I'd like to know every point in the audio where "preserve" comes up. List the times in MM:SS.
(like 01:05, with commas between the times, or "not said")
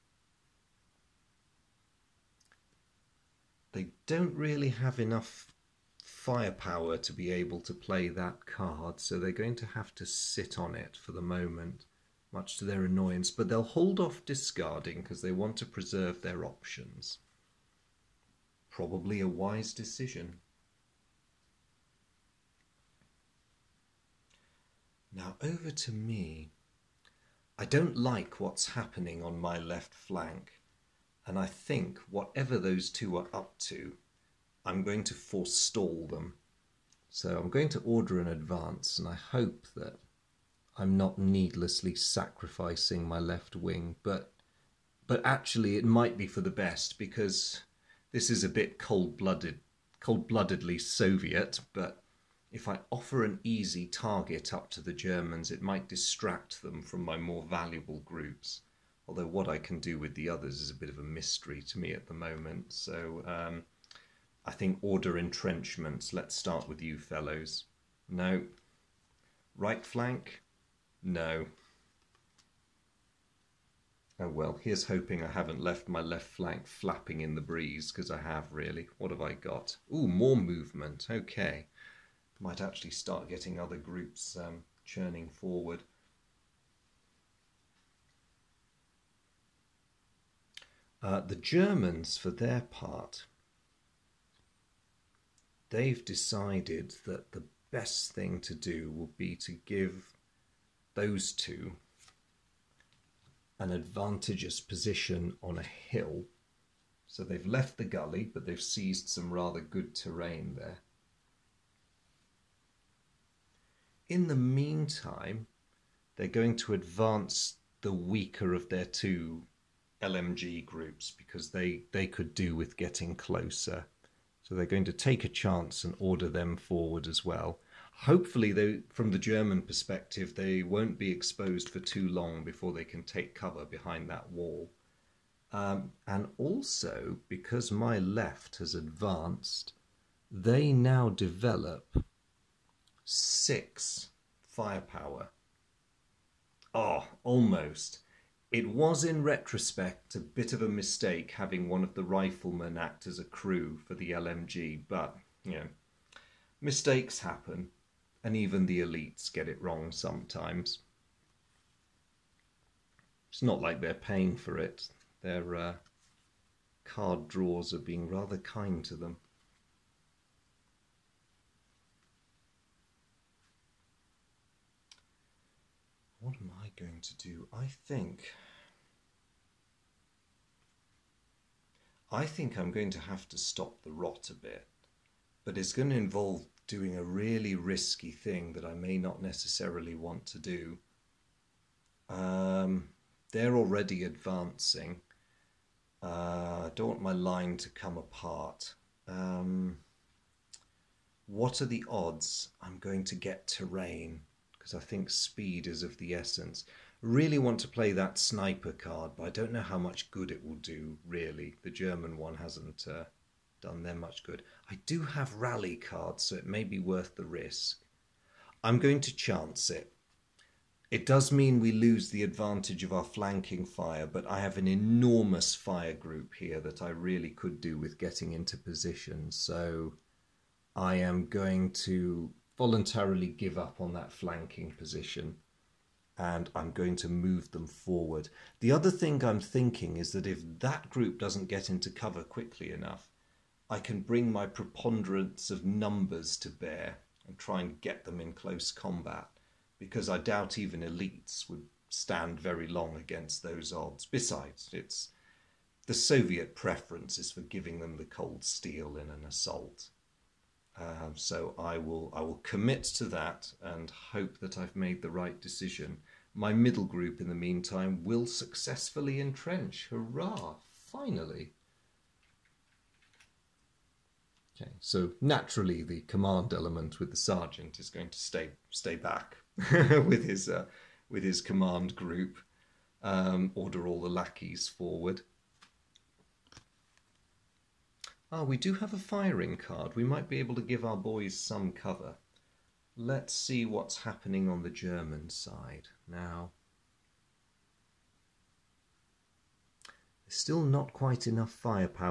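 00:15.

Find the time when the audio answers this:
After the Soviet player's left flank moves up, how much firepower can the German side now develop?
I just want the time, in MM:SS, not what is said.
02:23.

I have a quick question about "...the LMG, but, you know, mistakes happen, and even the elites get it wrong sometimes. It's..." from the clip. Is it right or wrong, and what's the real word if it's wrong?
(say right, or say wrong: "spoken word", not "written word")
right.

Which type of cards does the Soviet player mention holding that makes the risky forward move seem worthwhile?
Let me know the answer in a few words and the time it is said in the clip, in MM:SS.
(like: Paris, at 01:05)
Rally cards, at 03:35.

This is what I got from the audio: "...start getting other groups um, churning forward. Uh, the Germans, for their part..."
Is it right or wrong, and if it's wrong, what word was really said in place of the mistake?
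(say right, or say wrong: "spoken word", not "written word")
right.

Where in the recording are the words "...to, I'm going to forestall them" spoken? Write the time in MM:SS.
00:33.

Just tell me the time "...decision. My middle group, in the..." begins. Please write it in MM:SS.
04:25.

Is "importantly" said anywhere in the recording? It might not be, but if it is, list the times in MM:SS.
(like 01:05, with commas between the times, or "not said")
not said.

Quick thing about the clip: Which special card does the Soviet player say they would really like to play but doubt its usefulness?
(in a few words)
Sniper card.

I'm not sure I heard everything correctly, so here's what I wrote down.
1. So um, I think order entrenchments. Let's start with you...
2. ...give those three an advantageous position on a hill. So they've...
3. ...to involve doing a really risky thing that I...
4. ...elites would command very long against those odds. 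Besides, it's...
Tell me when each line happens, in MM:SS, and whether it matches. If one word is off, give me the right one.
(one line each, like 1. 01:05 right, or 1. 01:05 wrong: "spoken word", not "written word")
1. 01:02 right
2. 01:39 wrong: "two", not "three"
3. 03:05 right
4. 04:10 wrong: "stand", not "command".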